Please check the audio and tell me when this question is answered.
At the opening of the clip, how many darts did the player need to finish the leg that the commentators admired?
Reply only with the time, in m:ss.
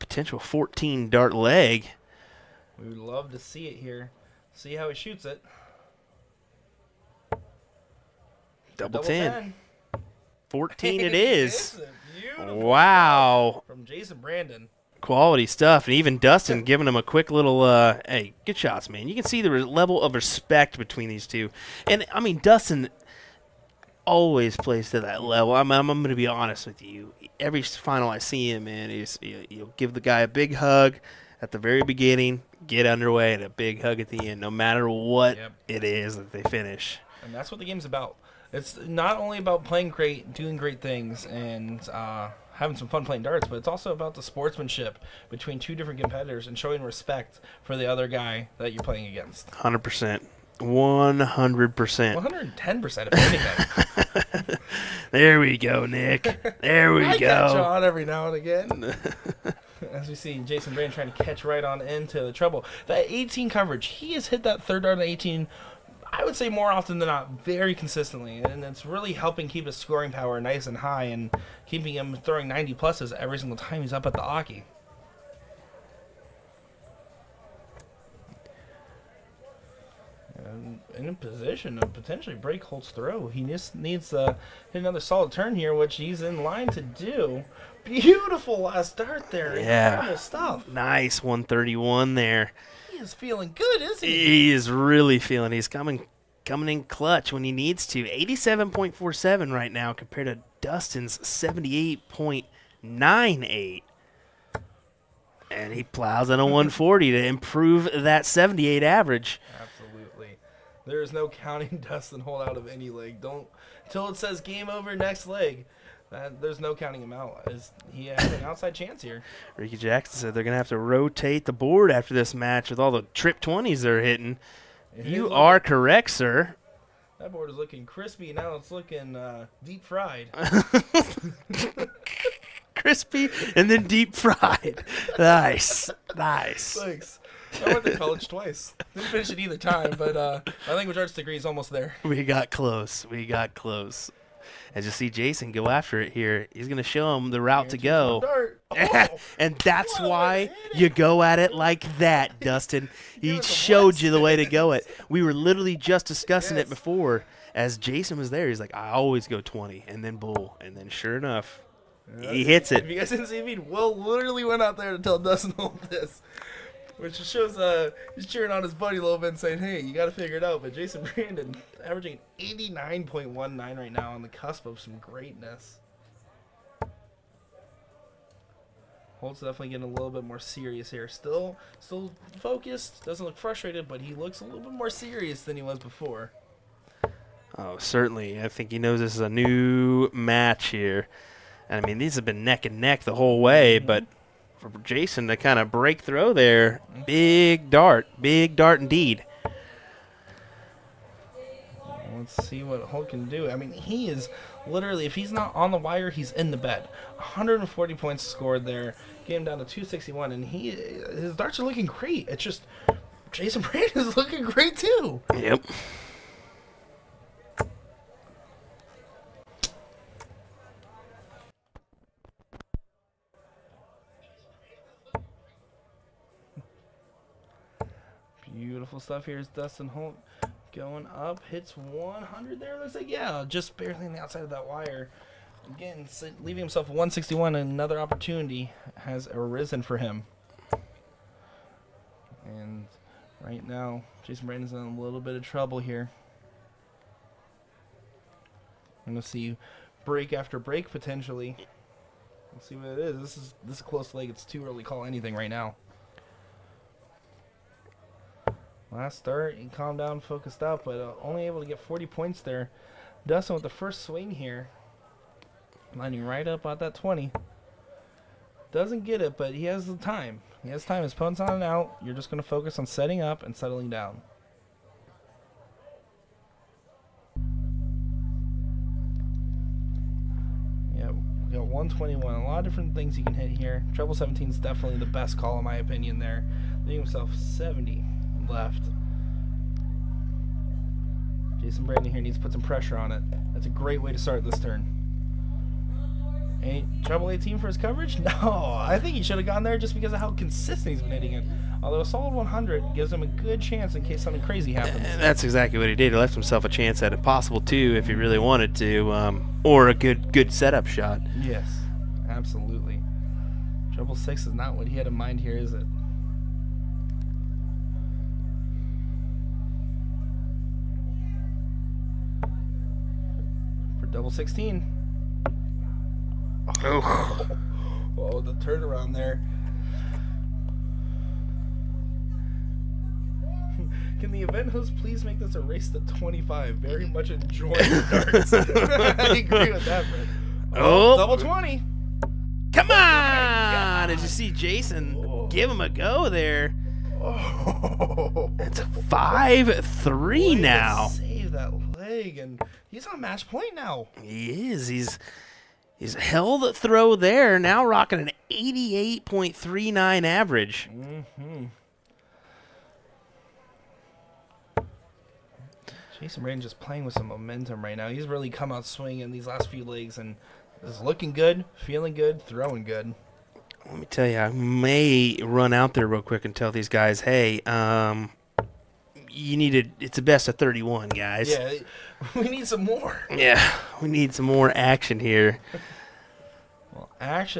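0:00.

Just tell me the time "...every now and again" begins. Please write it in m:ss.
0:57.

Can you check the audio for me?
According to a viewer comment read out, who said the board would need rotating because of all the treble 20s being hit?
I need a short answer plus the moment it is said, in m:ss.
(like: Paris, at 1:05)
Ricky Jackson, at 1:59.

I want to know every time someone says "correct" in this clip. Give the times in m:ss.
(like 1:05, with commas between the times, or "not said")
2:05.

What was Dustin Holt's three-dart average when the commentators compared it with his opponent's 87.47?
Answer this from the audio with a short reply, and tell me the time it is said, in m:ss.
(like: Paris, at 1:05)
78.98, at 1:41.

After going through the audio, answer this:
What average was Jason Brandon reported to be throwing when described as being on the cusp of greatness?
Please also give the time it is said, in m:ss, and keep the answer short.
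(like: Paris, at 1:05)
89.19, at 2:52.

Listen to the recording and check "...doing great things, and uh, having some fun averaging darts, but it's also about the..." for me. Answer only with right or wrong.
wrong.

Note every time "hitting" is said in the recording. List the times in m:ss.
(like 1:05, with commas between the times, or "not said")
2:04, 5:01.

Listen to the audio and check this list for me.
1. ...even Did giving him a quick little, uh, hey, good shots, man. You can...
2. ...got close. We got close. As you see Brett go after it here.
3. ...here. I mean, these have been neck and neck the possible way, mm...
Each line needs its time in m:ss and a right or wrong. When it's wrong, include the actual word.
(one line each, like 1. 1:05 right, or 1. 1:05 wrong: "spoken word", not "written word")
1. 0:15 wrong: "Dustin", not "Did"
2. 2:22 wrong: "Jason", not "Brett"
3. 3:10 wrong: "whole", not "possible".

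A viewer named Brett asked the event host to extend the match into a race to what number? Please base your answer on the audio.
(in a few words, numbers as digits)
25.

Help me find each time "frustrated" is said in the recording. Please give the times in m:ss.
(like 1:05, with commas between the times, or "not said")
3:03.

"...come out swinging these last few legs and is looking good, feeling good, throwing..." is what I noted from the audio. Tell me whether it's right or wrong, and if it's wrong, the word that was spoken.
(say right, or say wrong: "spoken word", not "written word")
right.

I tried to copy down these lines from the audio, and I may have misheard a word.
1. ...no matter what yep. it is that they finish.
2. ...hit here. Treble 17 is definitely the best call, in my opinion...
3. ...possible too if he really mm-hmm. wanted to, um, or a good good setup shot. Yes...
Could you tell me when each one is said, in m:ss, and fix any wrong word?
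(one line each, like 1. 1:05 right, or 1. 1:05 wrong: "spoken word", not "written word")
1. 0:34 right
2. 4:43 right
3. 5:07 right.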